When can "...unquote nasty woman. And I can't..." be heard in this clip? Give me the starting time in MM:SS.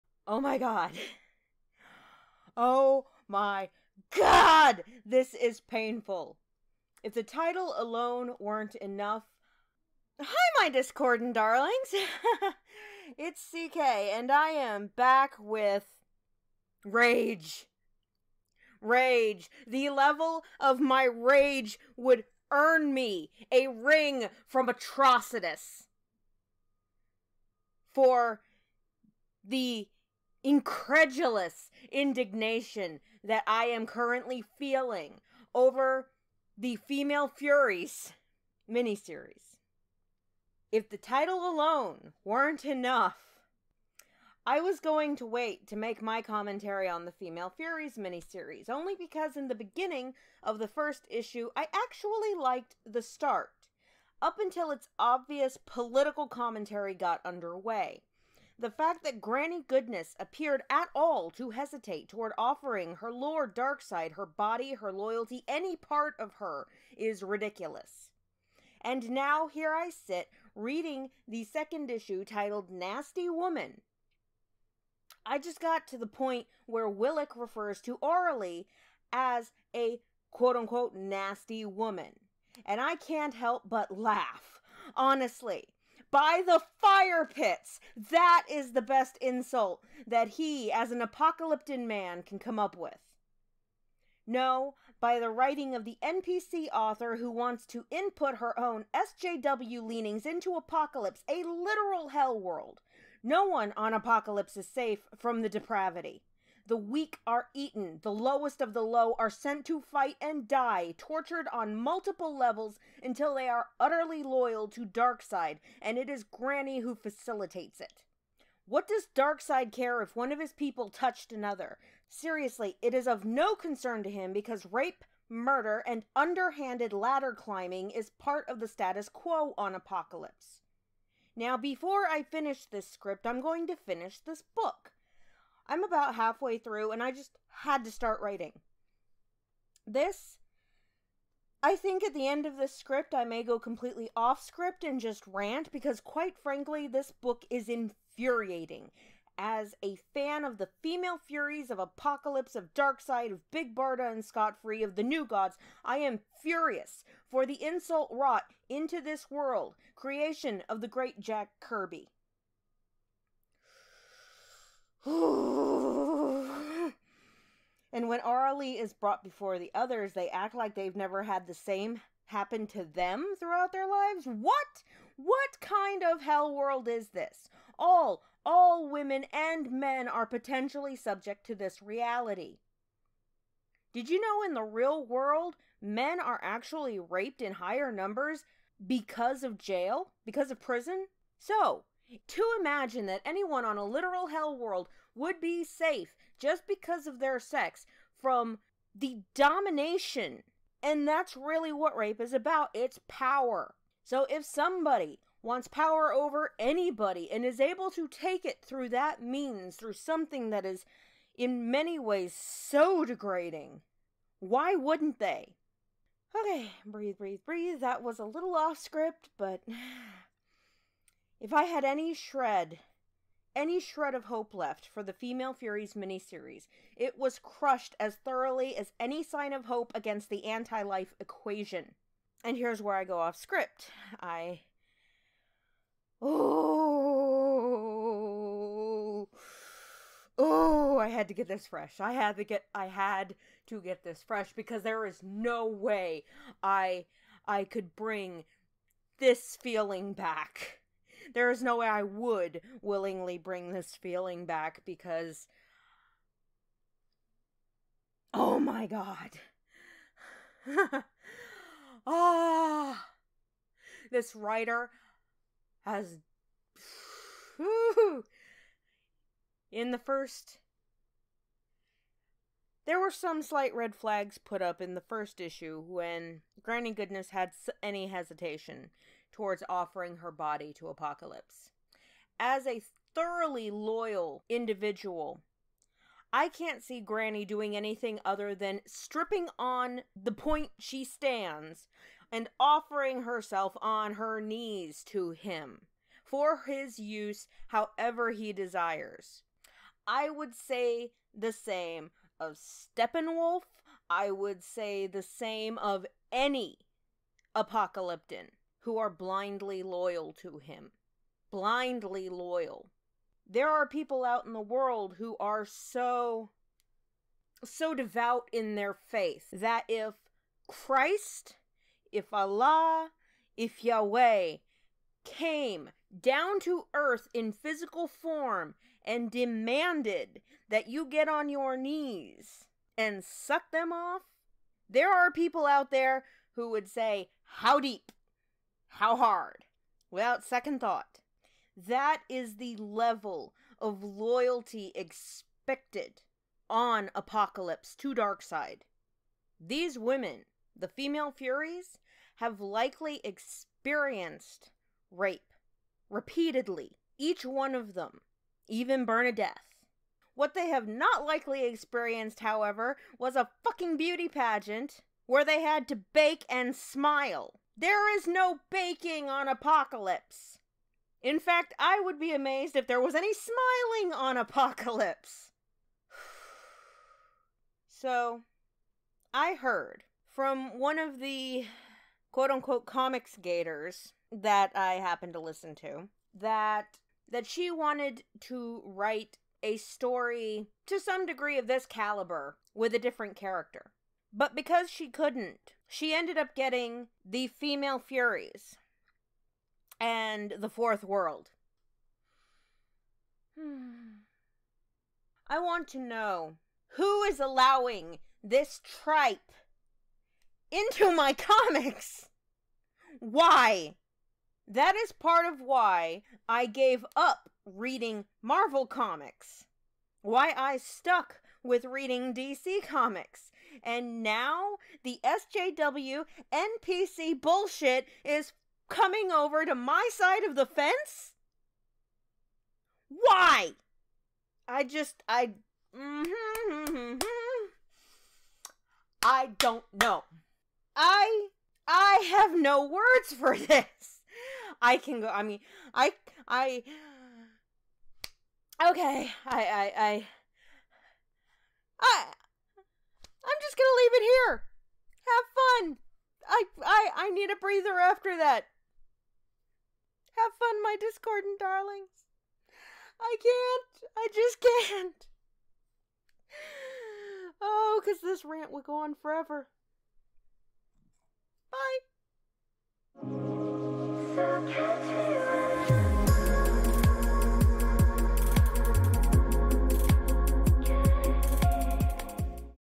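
01:20.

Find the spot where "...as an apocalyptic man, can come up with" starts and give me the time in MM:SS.
01:30.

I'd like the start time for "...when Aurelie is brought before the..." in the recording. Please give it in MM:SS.
02:48.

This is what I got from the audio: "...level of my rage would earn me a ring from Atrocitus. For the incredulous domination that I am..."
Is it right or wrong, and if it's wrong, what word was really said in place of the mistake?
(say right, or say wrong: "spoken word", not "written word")
wrong: "indignation", not "domination".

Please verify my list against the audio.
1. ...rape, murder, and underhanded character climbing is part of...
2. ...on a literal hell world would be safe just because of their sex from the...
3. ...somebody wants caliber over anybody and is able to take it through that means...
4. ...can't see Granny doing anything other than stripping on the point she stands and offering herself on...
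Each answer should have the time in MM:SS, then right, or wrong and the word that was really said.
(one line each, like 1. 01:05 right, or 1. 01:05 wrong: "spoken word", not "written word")
1. 02:04 wrong: "ladder", not "character"
2. 03:13 right
3. 03:24 wrong: "power", not "caliber"
4. 04:46 right.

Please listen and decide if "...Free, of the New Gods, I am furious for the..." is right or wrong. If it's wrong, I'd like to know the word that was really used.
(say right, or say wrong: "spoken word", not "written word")
right.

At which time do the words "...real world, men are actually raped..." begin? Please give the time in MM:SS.
03:04.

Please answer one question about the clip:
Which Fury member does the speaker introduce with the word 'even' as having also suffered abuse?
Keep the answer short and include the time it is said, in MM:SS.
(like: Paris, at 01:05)
Bernadeth, at 05:59.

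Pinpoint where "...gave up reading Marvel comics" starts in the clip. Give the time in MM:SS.
06:56.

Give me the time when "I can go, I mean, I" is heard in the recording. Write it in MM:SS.
07:24.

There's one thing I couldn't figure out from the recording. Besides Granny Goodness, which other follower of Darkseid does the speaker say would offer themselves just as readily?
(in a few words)
Steppenwolf.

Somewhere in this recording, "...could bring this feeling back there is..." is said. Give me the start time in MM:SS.
04:07.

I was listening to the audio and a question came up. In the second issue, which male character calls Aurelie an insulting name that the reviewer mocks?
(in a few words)
Willik.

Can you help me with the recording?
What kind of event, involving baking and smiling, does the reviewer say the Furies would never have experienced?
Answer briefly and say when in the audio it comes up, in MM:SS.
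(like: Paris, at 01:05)
beauty pageant, at 06:03.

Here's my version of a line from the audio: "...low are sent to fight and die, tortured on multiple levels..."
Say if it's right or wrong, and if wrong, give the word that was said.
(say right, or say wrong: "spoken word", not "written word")
right.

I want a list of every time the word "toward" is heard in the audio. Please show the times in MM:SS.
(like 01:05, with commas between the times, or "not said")
01:02, 04:39.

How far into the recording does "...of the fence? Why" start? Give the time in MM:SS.
07:10.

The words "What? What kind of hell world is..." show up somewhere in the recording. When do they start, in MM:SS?
02:54.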